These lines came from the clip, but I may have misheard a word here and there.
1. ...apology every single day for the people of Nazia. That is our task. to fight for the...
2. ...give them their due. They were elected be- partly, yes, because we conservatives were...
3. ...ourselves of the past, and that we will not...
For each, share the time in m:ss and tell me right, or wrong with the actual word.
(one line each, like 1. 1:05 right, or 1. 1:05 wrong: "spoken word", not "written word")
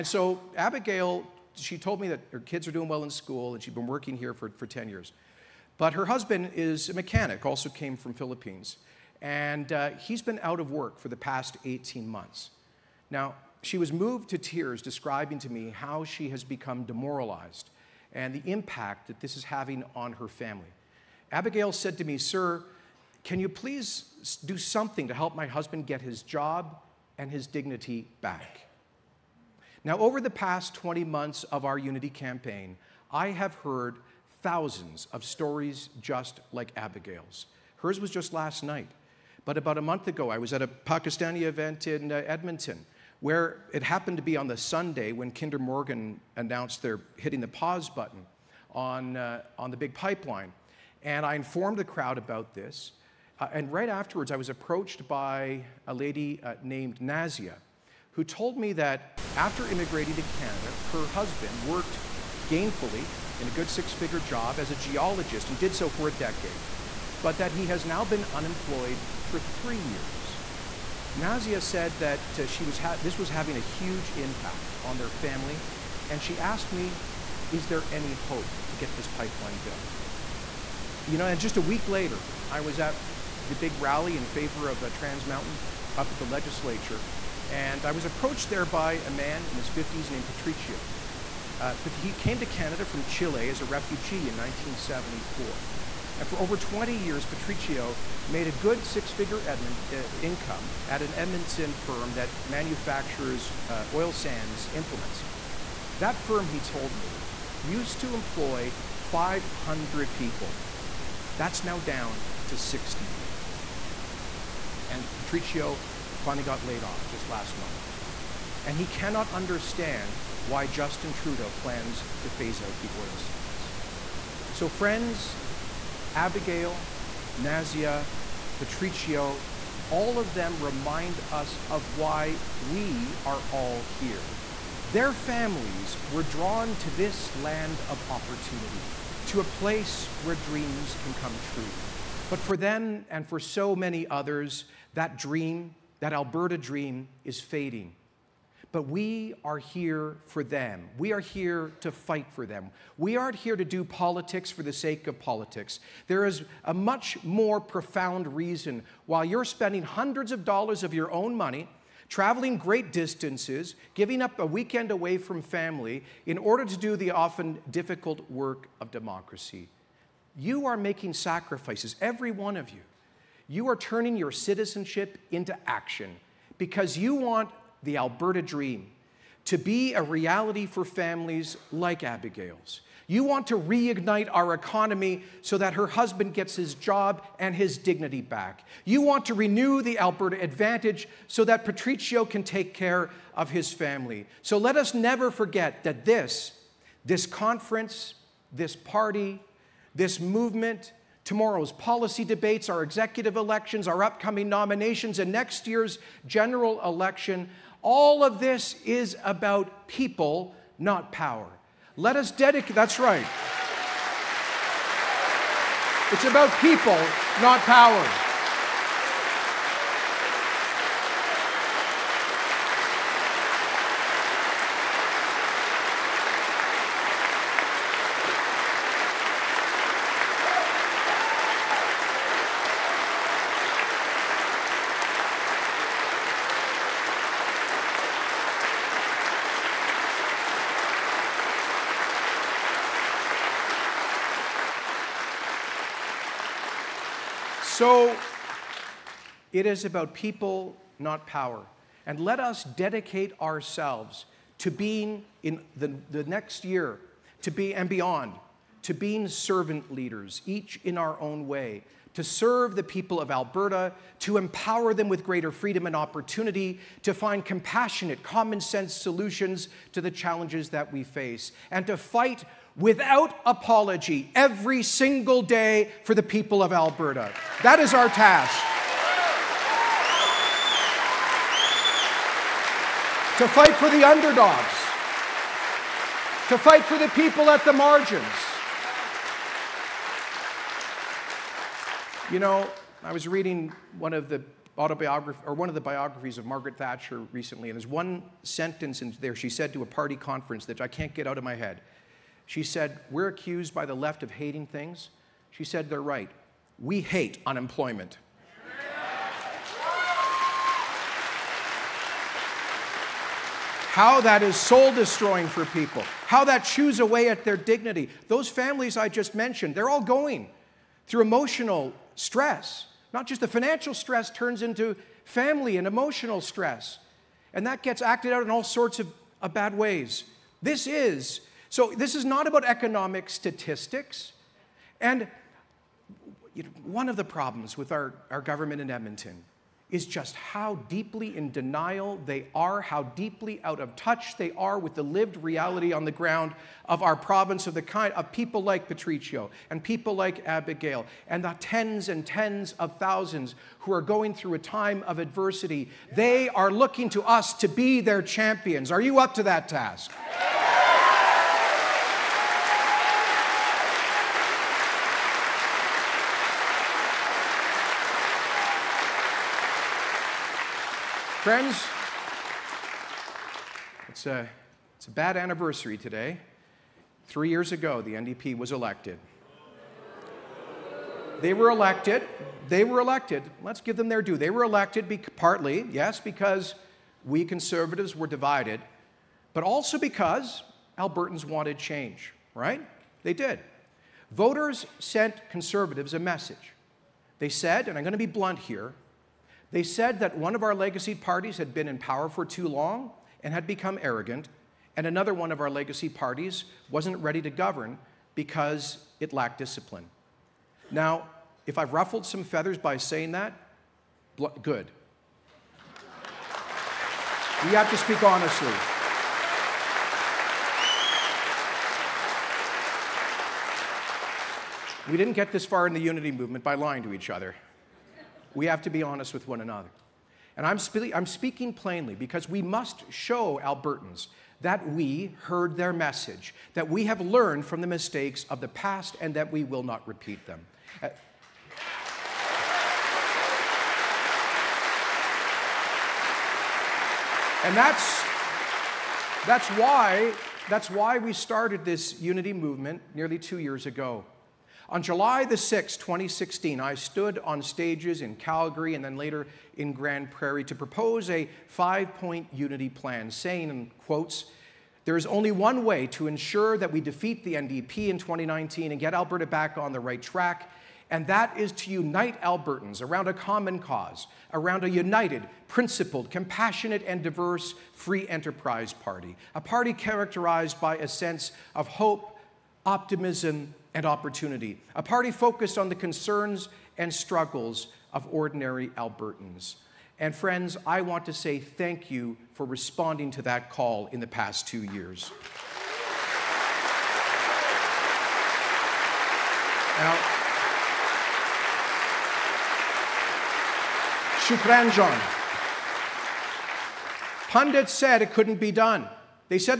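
1. 4:33 wrong: "Alberta", not "Nazia"
2. 6:23 right
3. 7:17 wrong: "mistakes", not "ourselves".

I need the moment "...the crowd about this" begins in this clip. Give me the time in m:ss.
0:51.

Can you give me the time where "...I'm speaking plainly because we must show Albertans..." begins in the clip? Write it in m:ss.
7:11.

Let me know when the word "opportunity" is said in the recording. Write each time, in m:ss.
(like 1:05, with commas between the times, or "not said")
2:18, 4:25, 8:04.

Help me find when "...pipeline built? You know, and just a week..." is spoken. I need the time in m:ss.
1:19.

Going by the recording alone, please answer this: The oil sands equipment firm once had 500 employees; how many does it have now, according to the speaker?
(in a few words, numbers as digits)
60.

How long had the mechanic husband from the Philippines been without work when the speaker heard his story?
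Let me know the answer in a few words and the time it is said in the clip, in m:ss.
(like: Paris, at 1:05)
18 months, at 0:11.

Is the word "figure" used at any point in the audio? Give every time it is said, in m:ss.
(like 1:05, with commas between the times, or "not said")
1:03, 1:39.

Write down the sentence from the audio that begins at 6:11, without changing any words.
Friends, it's a, it's a bad anniversary today.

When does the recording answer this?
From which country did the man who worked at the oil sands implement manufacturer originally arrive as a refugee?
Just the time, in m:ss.
1:33.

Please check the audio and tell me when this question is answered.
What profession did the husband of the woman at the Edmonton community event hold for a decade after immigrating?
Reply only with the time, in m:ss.
1:04.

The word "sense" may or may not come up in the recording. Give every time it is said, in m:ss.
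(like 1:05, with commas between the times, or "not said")
4:28, 8:01.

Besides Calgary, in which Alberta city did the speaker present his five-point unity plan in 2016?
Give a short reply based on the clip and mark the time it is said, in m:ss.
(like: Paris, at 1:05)
Grande Prairie, at 7:39.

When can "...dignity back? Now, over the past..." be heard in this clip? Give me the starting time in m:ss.
0:27.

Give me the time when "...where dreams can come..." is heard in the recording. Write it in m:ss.
2:20.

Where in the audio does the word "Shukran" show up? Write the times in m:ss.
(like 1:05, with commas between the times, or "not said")
8:24.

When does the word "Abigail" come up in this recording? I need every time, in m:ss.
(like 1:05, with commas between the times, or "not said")
0:00, 0:21, 0:36, 2:06, 3:02, 5:50.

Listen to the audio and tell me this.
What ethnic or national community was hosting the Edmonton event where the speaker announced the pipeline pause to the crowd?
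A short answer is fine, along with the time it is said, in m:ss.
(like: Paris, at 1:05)
Pakistani, at 0:40.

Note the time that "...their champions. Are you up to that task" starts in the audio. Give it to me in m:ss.
5:58.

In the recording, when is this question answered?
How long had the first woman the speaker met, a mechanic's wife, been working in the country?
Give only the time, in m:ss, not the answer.
0:04.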